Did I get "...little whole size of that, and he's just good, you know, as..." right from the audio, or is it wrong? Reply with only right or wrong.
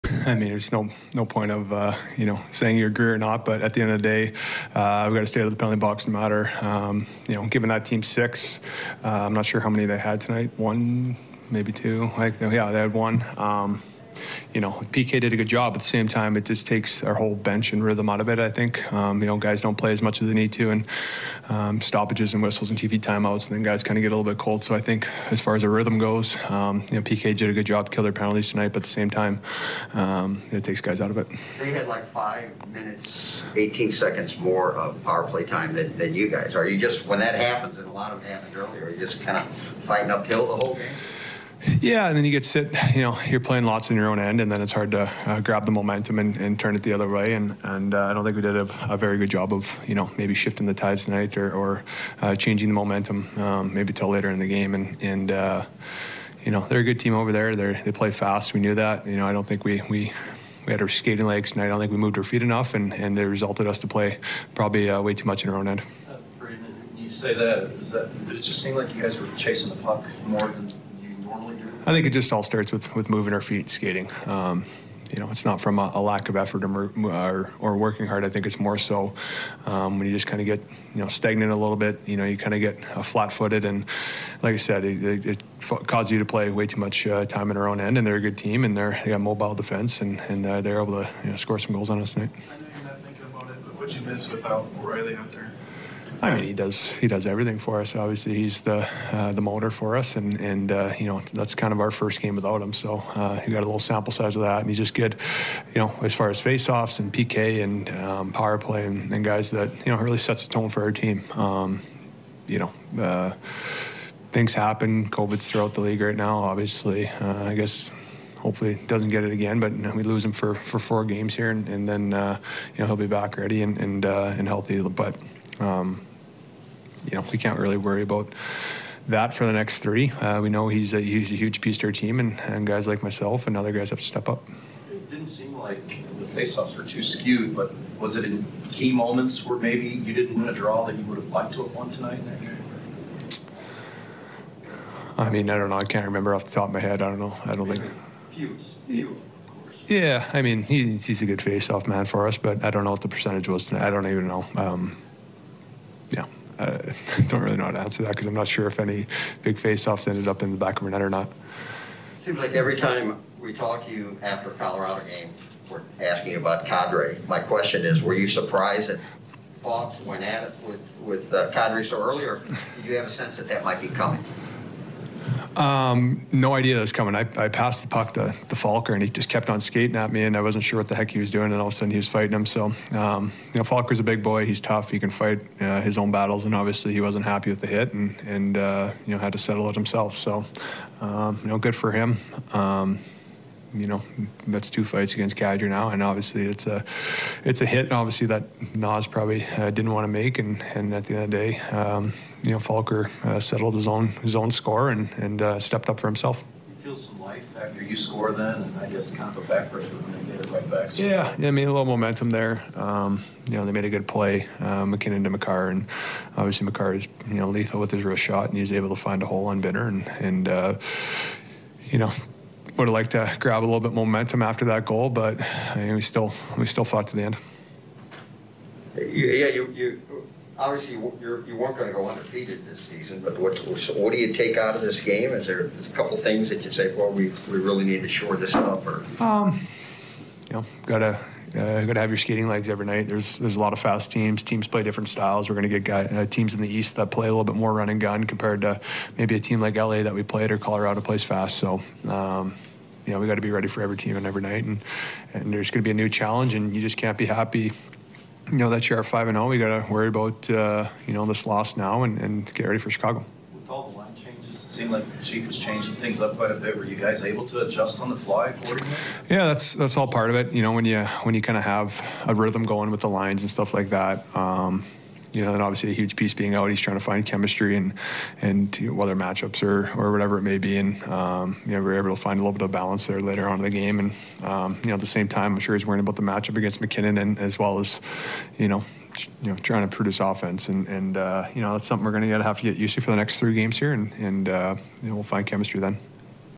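wrong.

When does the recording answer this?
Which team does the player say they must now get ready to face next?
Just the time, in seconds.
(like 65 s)
262 s.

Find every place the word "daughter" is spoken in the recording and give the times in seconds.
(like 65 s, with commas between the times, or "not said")
not said.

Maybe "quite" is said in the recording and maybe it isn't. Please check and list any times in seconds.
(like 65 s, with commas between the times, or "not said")
266 s.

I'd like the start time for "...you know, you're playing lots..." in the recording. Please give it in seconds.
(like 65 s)
42 s.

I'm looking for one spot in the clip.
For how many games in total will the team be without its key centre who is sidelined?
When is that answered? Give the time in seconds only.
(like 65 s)
120 s.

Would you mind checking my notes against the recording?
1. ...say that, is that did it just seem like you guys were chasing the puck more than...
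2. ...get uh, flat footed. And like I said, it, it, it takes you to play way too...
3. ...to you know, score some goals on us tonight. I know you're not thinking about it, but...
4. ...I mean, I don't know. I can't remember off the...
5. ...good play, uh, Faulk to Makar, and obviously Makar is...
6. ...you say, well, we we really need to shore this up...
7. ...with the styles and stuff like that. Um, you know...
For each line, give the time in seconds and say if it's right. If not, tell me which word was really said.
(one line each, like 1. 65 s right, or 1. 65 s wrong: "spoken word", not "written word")
1. 67 s right
2. 82 s wrong: "causes", not "takes"
3. 91 s right
4. 145 s right
5. 213 s wrong: "MacKinnon", not "Faulk"
6. 236 s right
7. 272 s wrong: "lines", not "styles".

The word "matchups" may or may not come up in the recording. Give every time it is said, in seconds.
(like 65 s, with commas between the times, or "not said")
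279 s, 286 s.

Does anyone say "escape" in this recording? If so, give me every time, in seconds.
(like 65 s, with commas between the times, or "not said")
not said.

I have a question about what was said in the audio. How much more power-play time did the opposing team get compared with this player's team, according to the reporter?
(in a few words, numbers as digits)
5 minutes, 18 seconds.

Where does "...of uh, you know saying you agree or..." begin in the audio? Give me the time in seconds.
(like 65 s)
1 s.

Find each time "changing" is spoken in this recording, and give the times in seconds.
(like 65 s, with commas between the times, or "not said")
52 s, 265 s.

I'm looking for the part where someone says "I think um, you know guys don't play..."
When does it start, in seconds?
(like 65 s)
18 s.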